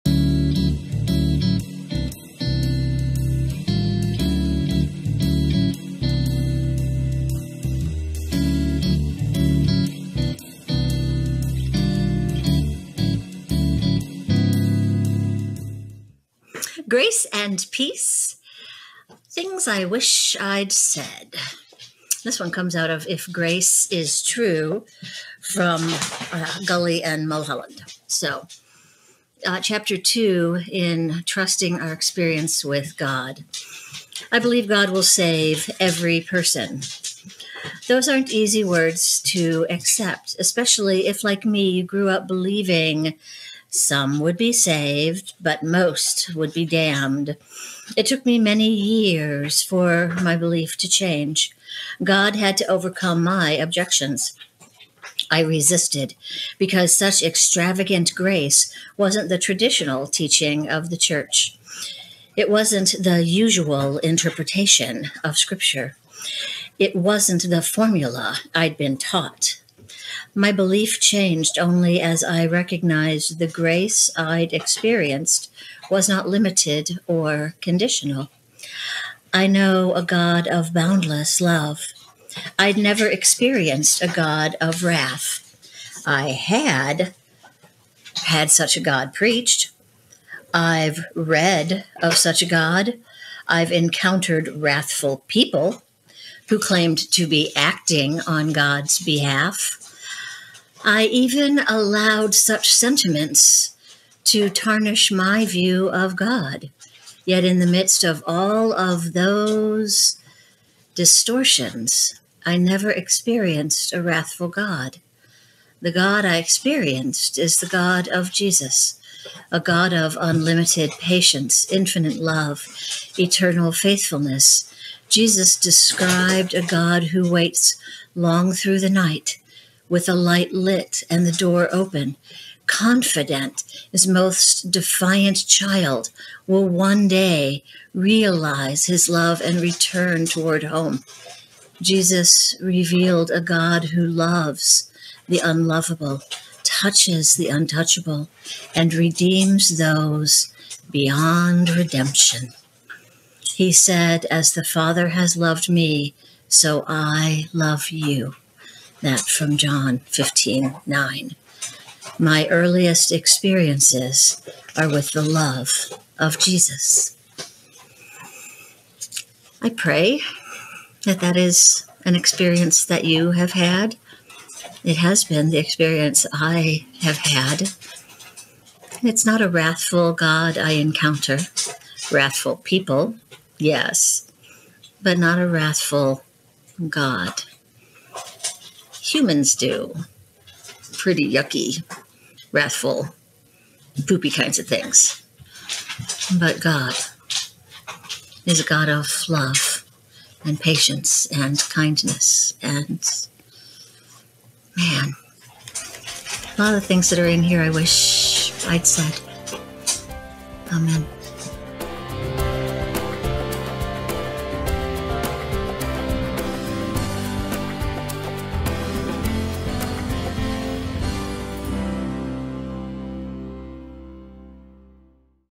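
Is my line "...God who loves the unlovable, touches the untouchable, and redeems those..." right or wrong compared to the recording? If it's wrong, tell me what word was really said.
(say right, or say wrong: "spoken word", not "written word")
right.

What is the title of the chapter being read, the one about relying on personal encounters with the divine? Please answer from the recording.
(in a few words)
Trusting Our Experience with God.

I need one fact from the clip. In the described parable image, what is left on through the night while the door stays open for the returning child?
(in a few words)
A light.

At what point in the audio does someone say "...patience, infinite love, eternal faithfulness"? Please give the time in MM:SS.
02:00.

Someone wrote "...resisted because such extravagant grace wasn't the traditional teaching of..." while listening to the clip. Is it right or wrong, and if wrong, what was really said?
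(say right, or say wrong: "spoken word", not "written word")
right.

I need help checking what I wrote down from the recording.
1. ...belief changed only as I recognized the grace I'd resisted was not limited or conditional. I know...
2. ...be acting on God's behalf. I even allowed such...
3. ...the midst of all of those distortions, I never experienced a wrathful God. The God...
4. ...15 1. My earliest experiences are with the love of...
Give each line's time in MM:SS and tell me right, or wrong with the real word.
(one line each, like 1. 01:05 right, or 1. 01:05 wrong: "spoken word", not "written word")
1. 01:10 wrong: "experienced", not "resisted"
2. 01:37 right
3. 01:47 right
4. 02:39 wrong: "9", not "1".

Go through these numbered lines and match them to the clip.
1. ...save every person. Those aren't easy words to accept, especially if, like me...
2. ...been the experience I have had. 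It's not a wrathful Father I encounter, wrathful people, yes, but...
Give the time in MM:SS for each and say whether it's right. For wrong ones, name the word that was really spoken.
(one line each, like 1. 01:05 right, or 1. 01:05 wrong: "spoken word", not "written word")
1. 00:35 right
2. 02:55 wrong: "God", not "Father".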